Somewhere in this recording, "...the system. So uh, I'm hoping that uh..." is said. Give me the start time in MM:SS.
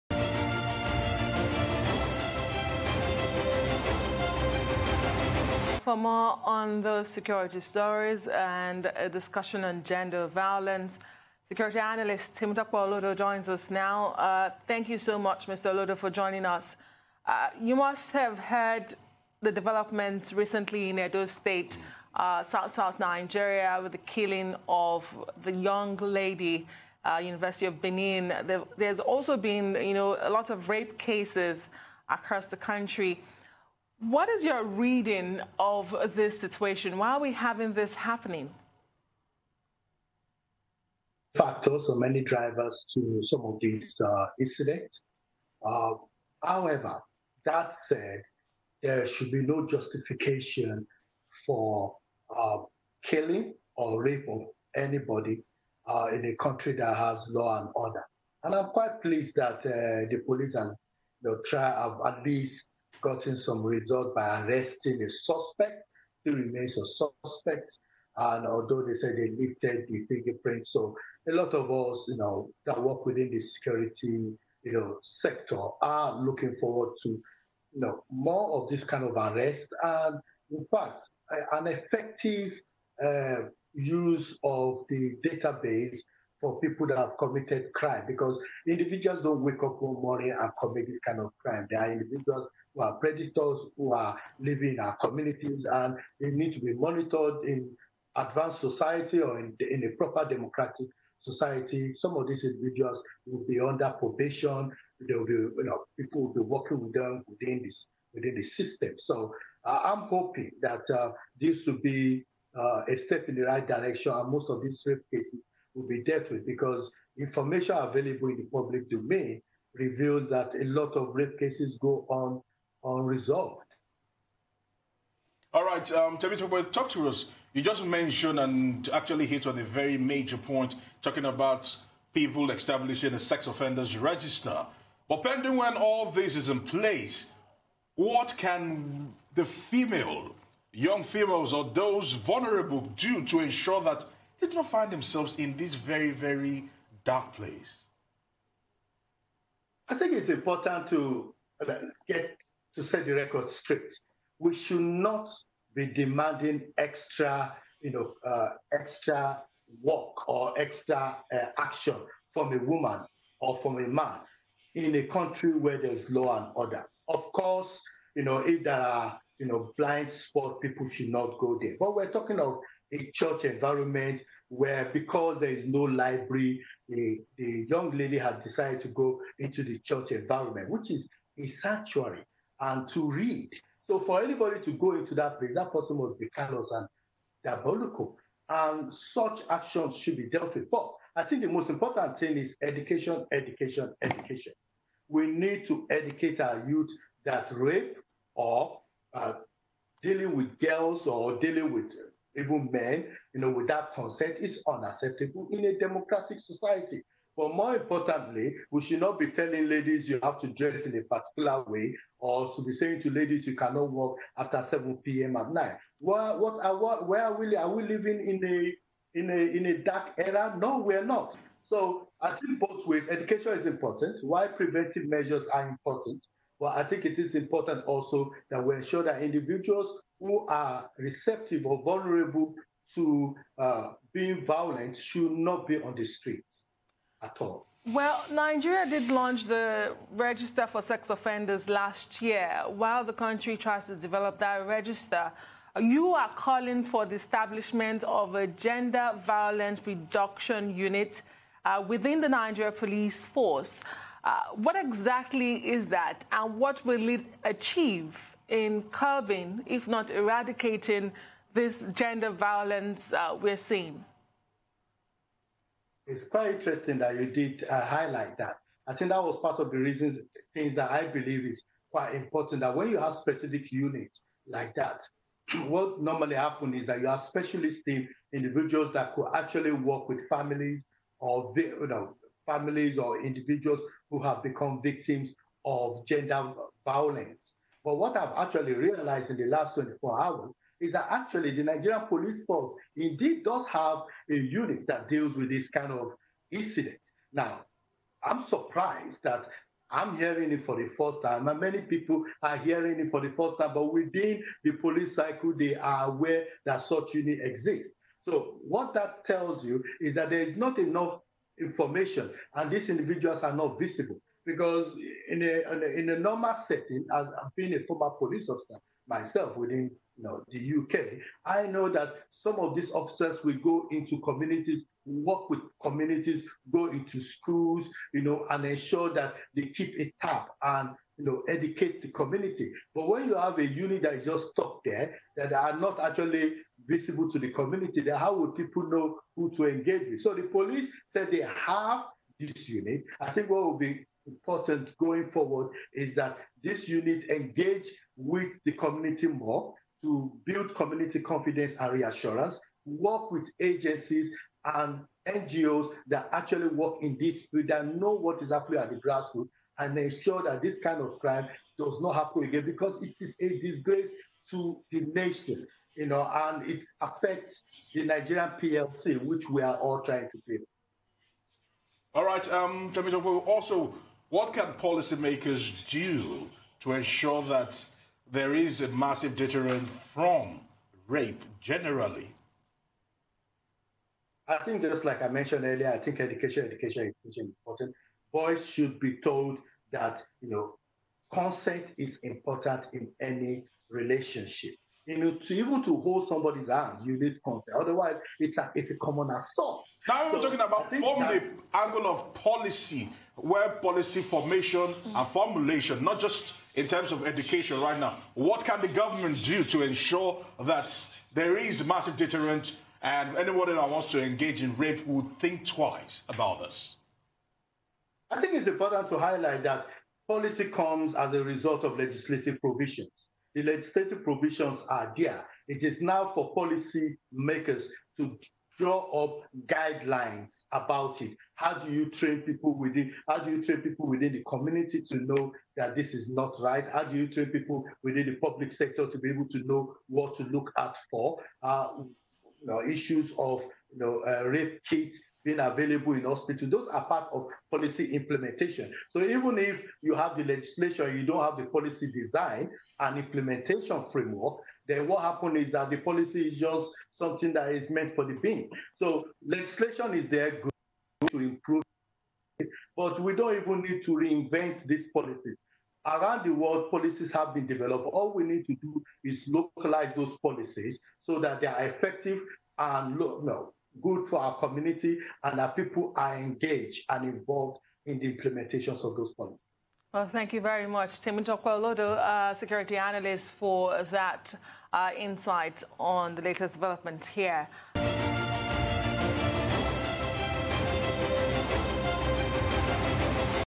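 01:48.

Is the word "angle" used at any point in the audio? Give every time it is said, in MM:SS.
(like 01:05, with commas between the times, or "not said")
06:41.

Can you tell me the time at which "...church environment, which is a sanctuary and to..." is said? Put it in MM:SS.
02:59.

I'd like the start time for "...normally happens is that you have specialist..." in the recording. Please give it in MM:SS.
04:36.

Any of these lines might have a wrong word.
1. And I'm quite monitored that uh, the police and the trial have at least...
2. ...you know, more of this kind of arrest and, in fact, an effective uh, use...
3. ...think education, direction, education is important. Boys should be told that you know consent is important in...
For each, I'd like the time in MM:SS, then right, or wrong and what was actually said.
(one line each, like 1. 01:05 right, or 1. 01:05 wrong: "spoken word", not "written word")
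1. 00:58 wrong: "pleased", not "monitored"
2. 01:17 right
3. 06:25 wrong: "education", not "direction".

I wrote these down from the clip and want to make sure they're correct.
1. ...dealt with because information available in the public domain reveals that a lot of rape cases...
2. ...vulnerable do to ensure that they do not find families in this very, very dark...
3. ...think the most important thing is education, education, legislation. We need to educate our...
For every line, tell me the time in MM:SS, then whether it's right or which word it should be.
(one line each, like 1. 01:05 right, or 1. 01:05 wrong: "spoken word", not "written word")
1. 01:56 right
2. 02:22 wrong: "themselves", not "families"
3. 03:11 wrong: "education", not "legislation".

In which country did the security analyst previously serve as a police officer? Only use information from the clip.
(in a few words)
UK.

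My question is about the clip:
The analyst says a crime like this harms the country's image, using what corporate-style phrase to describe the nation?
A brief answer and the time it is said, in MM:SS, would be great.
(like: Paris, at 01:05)
Nigerian PLC, at 06:08.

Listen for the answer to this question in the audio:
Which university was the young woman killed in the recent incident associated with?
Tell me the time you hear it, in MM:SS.
00:27.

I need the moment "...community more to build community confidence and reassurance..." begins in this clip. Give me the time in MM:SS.
05:48.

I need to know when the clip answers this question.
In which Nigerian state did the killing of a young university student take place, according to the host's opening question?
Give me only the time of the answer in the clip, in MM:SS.
00:20.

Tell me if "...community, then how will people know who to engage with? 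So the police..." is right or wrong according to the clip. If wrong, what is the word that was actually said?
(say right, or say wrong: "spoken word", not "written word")
right.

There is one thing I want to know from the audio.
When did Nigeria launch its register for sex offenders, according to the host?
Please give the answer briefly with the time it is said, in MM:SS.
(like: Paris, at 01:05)
Last year, at 04:01.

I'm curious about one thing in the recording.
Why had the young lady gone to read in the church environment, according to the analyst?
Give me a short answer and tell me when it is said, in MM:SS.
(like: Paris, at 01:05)
No library, at 02:55.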